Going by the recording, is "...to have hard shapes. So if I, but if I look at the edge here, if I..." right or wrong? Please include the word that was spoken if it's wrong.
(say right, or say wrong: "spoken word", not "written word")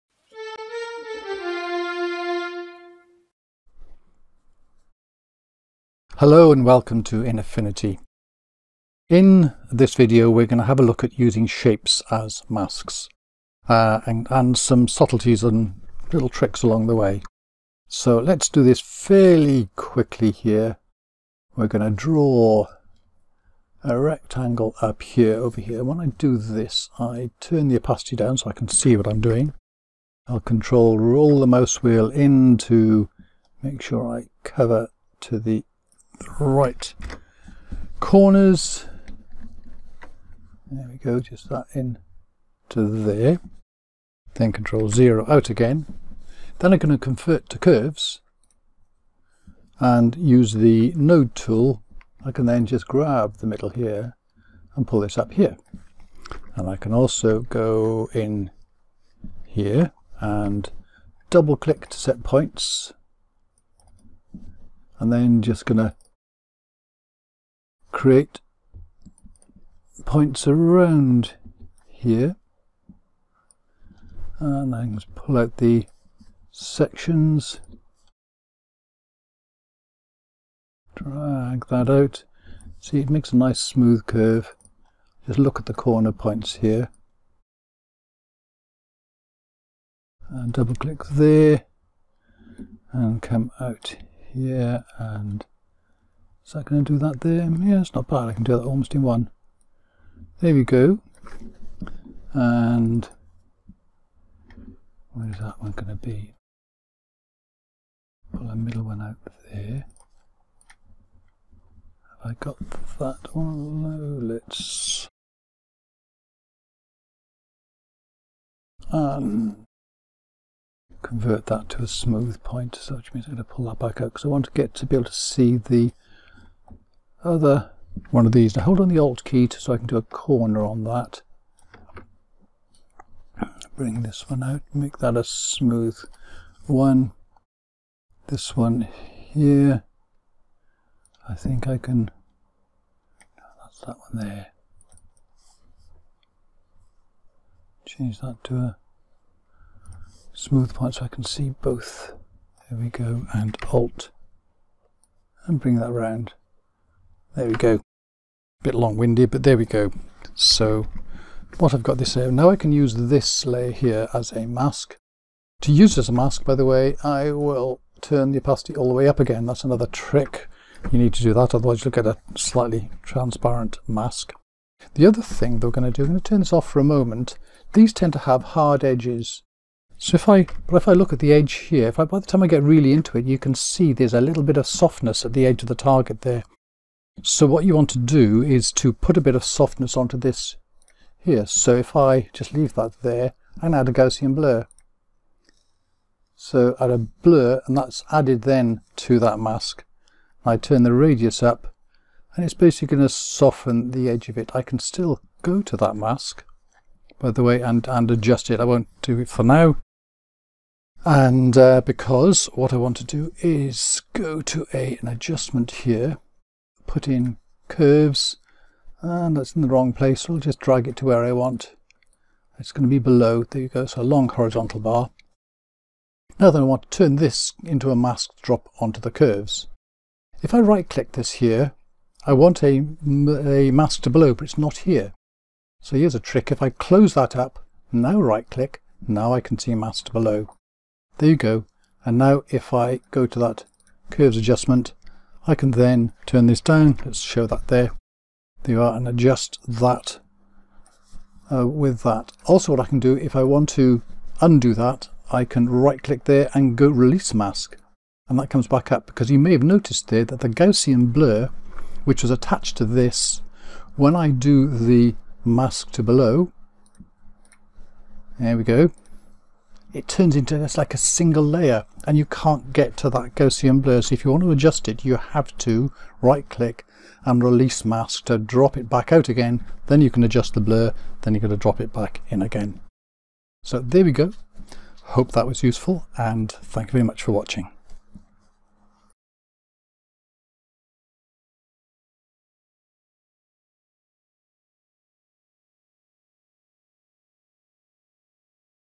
wrong: "edges", not "shapes".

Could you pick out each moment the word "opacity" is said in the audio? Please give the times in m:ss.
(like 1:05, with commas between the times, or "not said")
0:27, 2:48.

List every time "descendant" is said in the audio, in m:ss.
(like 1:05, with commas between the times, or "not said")
not said.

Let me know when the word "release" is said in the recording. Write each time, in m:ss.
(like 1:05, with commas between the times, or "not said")
4:16, 4:37.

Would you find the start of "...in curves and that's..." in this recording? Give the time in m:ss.
3:37.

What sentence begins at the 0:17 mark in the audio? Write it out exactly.
So let's do this fairly quickly here.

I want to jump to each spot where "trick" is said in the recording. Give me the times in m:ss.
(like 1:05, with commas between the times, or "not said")
0:16, 2:49, 3:56.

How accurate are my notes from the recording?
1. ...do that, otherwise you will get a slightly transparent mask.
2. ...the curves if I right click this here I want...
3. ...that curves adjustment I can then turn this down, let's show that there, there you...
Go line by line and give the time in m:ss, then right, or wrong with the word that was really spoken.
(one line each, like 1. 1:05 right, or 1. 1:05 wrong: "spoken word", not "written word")
1. 2:51 right
2. 3:48 right
3. 4:03 right.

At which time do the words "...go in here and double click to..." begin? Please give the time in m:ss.
0:57.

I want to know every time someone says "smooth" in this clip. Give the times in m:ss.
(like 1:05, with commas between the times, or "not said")
1:23, 2:01, 2:15, 2:30.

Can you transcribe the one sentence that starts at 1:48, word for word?
Pull the middle one out there.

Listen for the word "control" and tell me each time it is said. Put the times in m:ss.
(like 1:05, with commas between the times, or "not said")
0:30, 0:44.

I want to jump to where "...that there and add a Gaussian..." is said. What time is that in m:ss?
3:12.